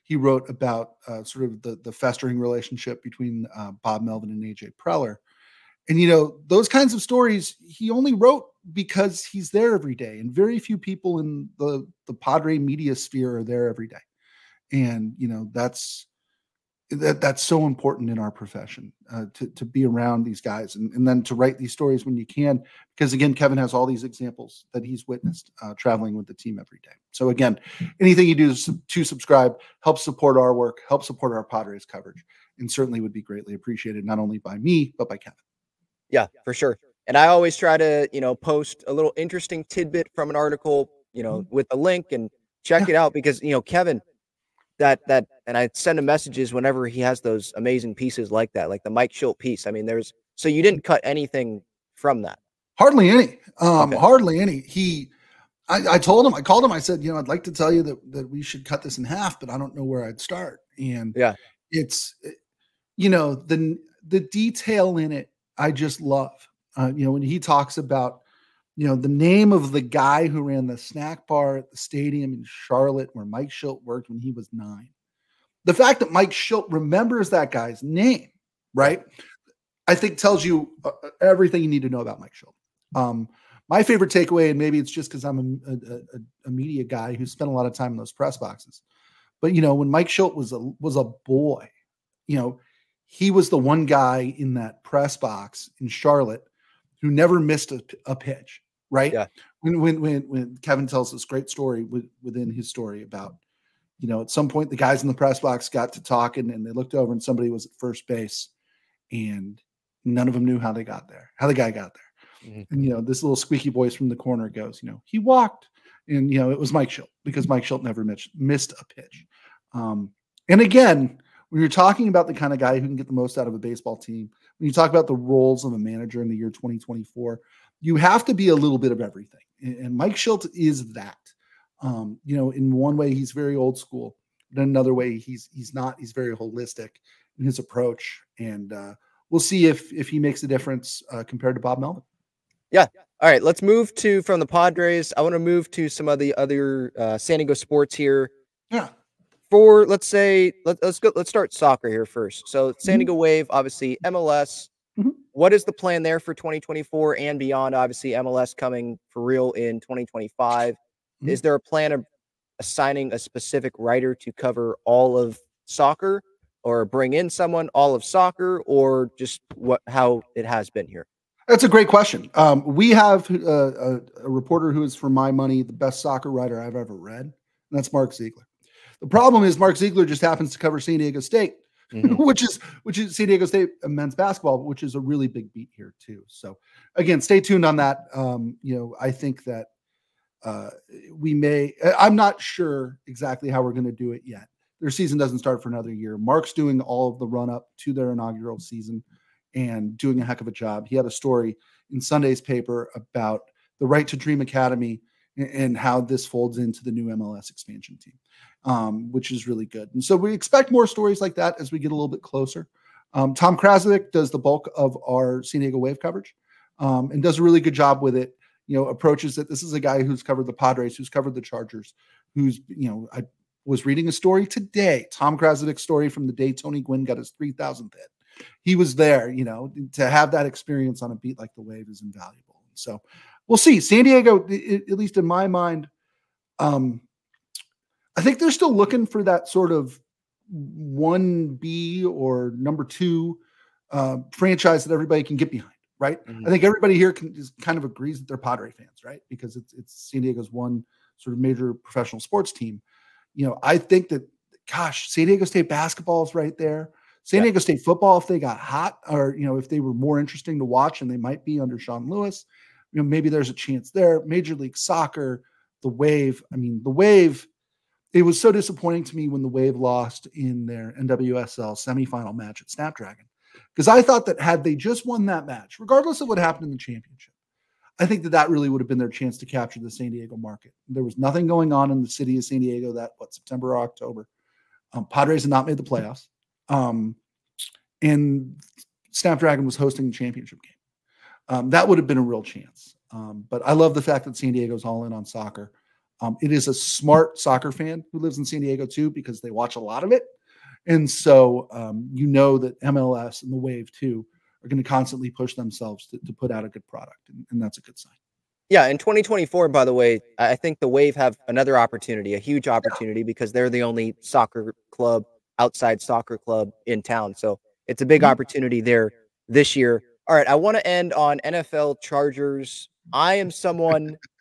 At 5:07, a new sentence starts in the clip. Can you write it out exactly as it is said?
And, and that's a good sign.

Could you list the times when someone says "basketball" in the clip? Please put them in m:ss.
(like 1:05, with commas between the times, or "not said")
3:04, 4:15.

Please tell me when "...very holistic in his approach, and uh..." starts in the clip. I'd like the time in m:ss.
2:16.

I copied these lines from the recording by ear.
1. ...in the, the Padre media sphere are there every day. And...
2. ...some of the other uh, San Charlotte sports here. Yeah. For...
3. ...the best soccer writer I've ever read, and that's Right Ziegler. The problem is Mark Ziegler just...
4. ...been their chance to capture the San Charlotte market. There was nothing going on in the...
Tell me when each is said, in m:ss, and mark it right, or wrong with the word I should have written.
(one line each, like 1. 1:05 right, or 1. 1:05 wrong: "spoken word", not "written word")
1. 0:11 right
2. 2:25 wrong: "Diego", not "Charlotte"
3. 2:55 wrong: "Mark", not "Right"
4. 4:38 wrong: "Diego", not "Charlotte".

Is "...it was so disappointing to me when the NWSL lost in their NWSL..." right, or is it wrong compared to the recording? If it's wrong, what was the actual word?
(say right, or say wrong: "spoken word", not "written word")
wrong: "Wave", not "NWSL".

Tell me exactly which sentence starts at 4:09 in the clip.
Because it's, it's San Diego's one sort of major professional sports team.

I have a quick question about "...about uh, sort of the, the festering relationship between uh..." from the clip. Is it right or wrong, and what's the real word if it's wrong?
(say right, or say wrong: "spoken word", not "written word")
right.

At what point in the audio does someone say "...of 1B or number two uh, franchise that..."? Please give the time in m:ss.
3:59.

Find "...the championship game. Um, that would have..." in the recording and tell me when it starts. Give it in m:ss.
4:50.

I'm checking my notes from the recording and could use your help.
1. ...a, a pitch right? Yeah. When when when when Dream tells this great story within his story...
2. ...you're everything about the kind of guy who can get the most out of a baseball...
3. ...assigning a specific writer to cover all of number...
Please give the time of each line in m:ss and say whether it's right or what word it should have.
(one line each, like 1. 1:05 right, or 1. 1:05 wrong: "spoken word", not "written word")
1. 1:37 wrong: "Kevin", not "Dream"
2. 2:01 wrong: "talking", not "everything"
3. 2:42 wrong: "soccer", not "number".